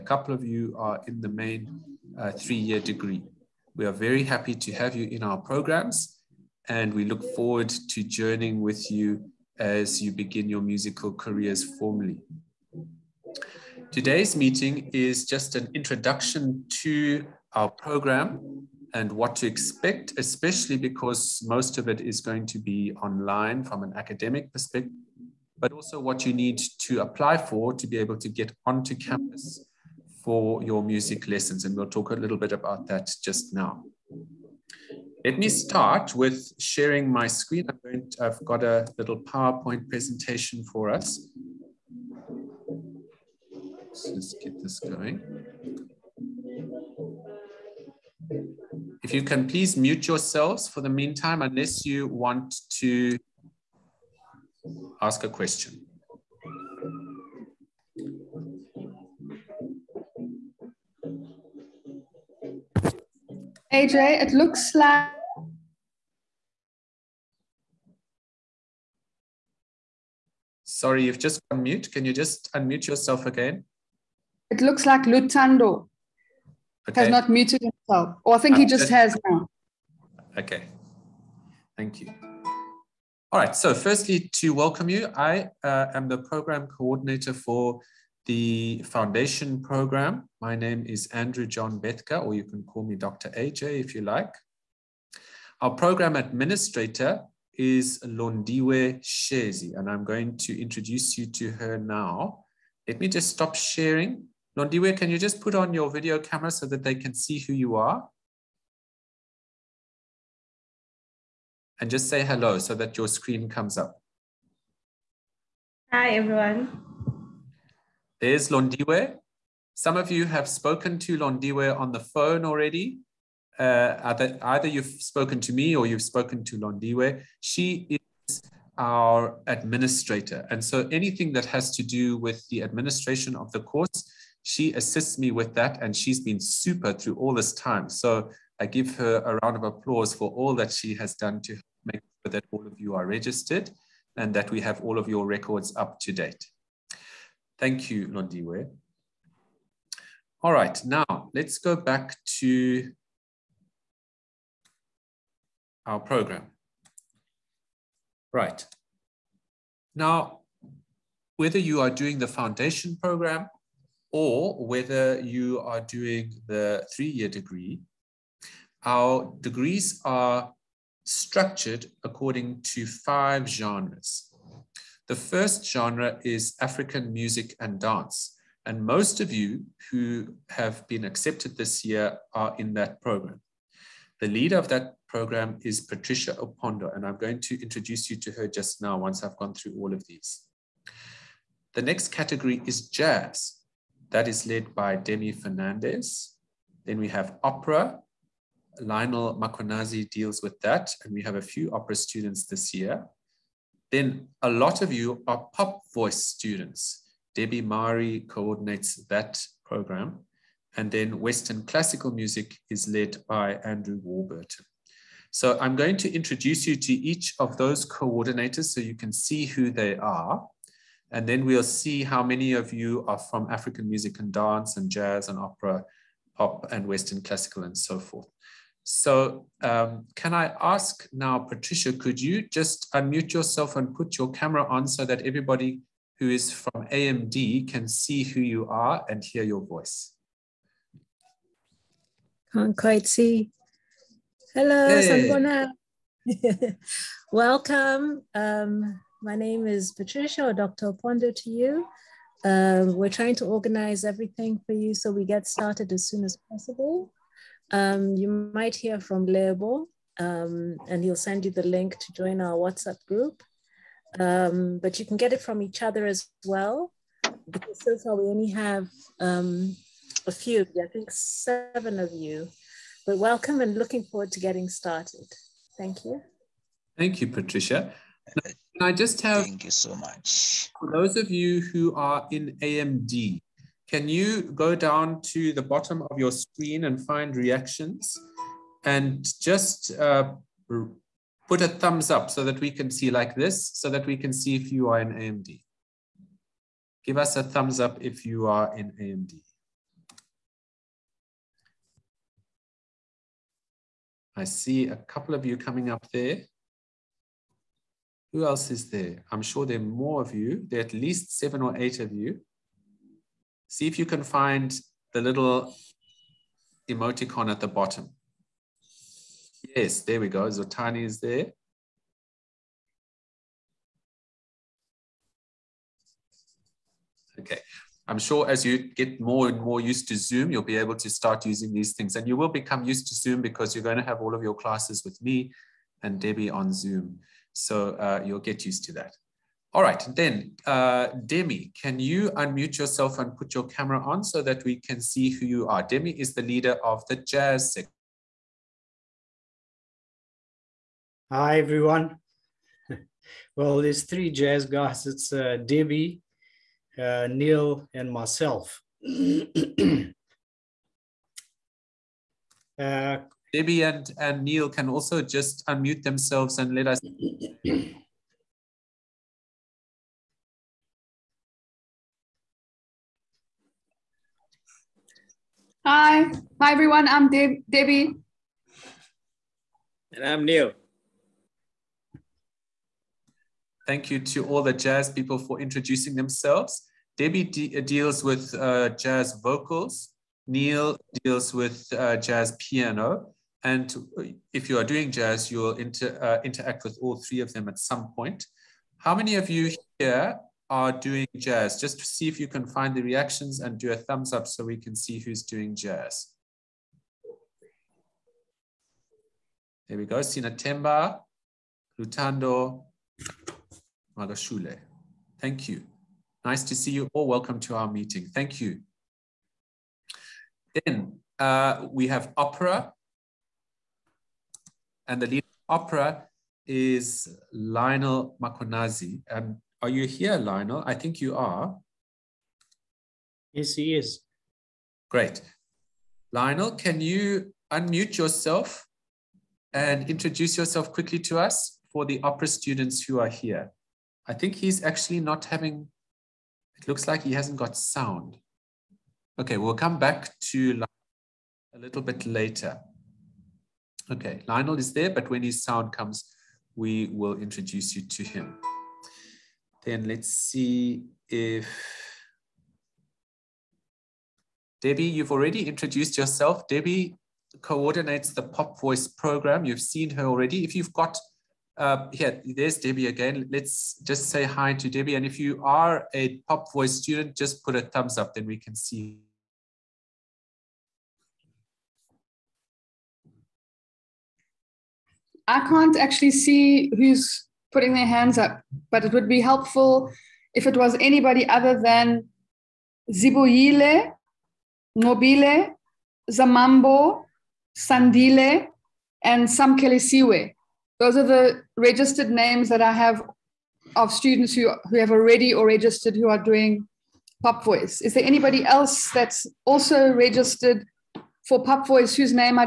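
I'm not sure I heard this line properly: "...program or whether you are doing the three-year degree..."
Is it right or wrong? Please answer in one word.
right.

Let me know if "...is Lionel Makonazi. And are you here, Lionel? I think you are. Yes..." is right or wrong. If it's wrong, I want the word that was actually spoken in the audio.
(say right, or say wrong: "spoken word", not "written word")
right.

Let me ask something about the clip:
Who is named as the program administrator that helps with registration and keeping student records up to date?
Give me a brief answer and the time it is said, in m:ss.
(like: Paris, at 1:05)
Londiwe Shezi, at 1:38.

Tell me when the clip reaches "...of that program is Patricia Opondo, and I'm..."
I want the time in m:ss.
3:04.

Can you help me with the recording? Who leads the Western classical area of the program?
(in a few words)
Andrew Warburton.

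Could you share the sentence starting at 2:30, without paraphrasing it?
All right, now let's go back to our program.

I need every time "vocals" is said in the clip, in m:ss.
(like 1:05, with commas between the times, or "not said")
6:29.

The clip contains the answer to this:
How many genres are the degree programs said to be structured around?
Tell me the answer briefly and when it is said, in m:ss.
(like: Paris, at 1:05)
5, at 2:52.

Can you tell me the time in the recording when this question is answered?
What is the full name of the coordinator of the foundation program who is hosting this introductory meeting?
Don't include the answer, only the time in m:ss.
1:31.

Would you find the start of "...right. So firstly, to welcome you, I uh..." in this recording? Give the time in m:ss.
1:23.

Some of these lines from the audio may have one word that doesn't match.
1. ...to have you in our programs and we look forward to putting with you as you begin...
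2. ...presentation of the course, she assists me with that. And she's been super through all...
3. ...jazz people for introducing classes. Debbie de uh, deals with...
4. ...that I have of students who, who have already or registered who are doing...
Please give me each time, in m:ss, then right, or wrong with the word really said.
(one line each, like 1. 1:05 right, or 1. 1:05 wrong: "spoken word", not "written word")
1. 0:04 wrong: "journeying", not "putting"
2. 2:12 wrong: "administration", not "presentation"
3. 6:24 wrong: "themselves", not "classes"
4. 8:22 right.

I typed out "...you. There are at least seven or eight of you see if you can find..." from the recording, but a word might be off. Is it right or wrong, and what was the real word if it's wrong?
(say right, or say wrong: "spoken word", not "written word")
right.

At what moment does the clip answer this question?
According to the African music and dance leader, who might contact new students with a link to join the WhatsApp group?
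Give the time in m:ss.
4:19.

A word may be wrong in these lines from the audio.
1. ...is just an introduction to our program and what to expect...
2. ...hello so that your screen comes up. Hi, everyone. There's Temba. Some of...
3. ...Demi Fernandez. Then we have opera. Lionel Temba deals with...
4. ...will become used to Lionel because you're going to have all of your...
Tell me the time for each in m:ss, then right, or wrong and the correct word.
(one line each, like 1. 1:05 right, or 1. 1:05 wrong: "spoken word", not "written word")
1. 0:14 right
2. 1:52 wrong: "Londiwe", not "Temba"
3. 3:14 wrong: "Makonazi", not "Temba"
4. 5:32 wrong: "Zoom", not "Lionel".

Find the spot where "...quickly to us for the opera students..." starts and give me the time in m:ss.
7:20.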